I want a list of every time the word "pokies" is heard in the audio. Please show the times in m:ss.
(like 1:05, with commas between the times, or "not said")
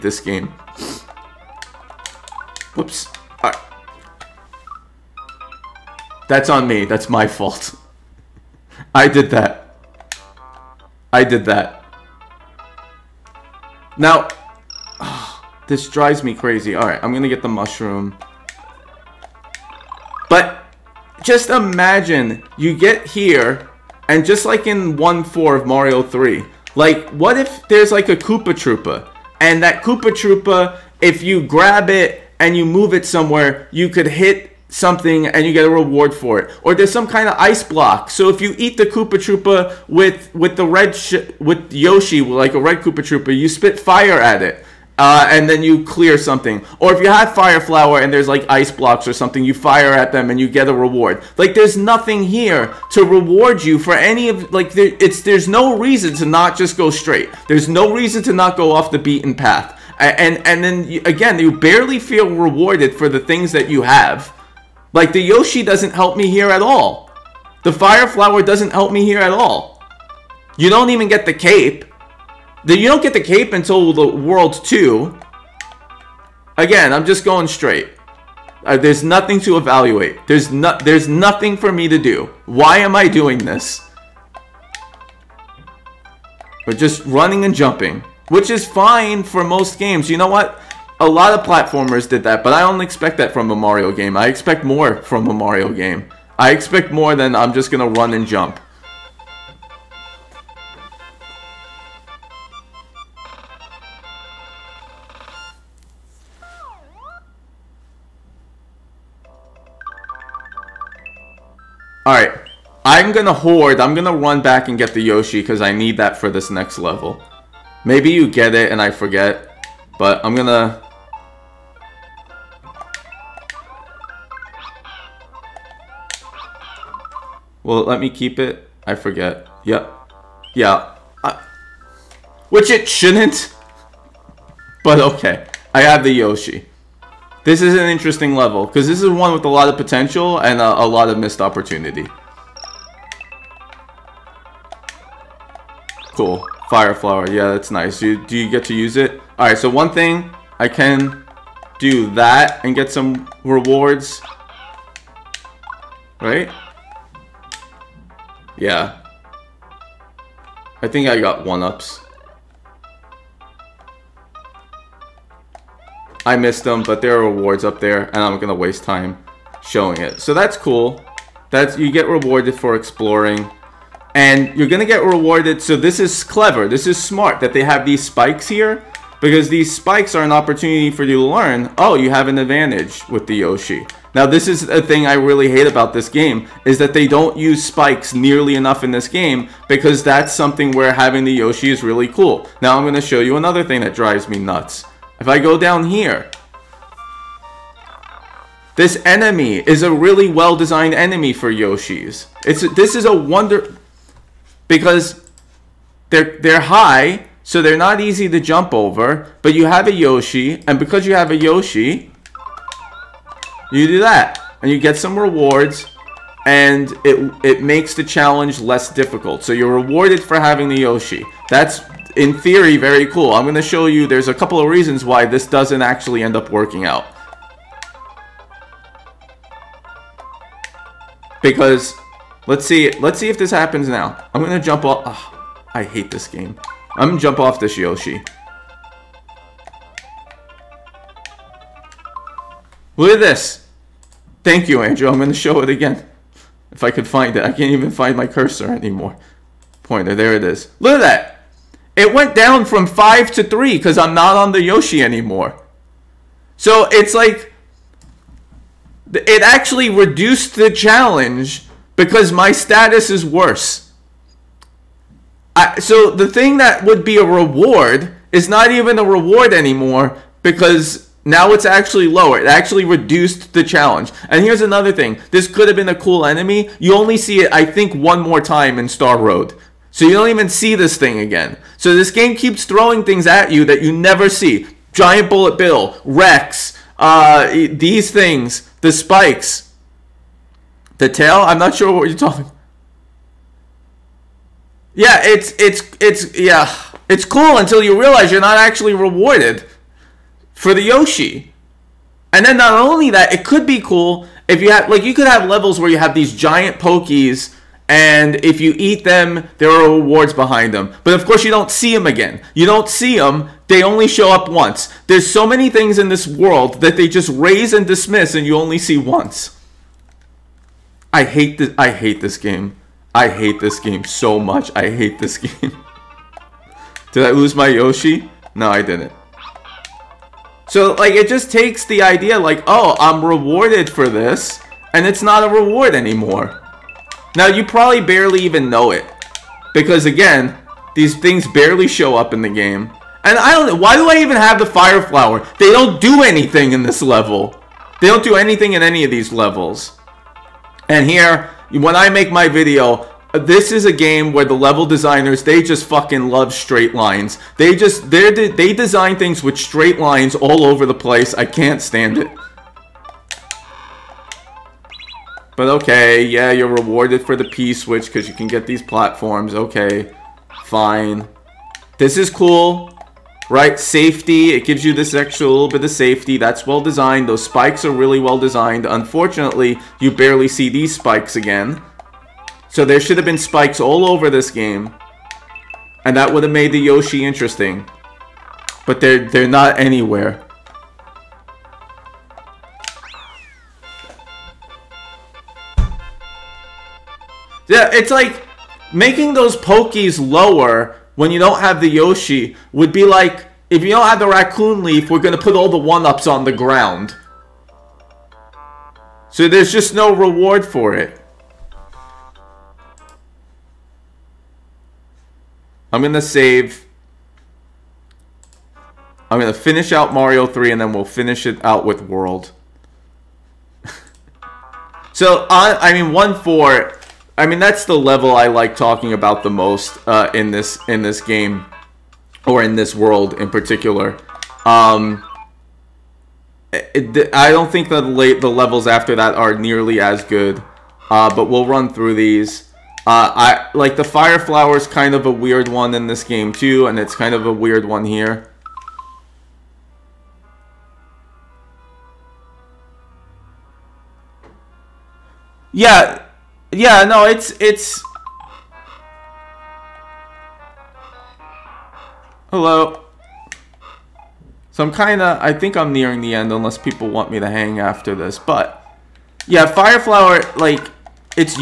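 5:06, 6:39.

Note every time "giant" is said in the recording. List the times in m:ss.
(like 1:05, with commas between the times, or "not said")
4:44, 5:06.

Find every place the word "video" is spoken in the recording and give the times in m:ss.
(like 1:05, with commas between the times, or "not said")
5:52.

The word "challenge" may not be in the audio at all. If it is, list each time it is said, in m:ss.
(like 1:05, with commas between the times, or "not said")
3:38, 4:20, 4:33.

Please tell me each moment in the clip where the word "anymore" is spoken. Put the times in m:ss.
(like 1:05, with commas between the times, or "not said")
4:08, 4:15, 4:29, 5:35.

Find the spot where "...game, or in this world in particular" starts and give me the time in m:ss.
7:11.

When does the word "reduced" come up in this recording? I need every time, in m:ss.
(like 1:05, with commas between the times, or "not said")
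4:19, 4:32.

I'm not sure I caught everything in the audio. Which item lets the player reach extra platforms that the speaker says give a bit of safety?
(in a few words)
P switch.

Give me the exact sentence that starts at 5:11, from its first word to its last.
But of course, you don't see them again.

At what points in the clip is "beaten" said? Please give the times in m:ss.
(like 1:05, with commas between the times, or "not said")
0:58.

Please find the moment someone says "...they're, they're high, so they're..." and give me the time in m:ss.
3:26.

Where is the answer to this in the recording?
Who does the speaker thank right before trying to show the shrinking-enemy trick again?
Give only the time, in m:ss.
4:04.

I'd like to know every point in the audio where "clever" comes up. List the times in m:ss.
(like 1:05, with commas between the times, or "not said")
2:56.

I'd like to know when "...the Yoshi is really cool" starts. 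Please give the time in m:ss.
3:11.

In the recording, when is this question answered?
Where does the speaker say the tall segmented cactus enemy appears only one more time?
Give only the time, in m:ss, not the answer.
4:38.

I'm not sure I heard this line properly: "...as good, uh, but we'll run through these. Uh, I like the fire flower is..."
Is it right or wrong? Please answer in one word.
right.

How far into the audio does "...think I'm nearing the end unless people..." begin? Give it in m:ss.
7:45.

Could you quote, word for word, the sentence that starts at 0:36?
Or there's some kind of ice block.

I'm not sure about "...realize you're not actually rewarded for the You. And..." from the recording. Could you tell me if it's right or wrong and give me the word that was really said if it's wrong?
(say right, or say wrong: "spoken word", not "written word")
wrong: "Yoshi", not "You".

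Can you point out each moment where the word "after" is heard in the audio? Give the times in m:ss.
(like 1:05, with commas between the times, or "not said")
7:18, 7:47.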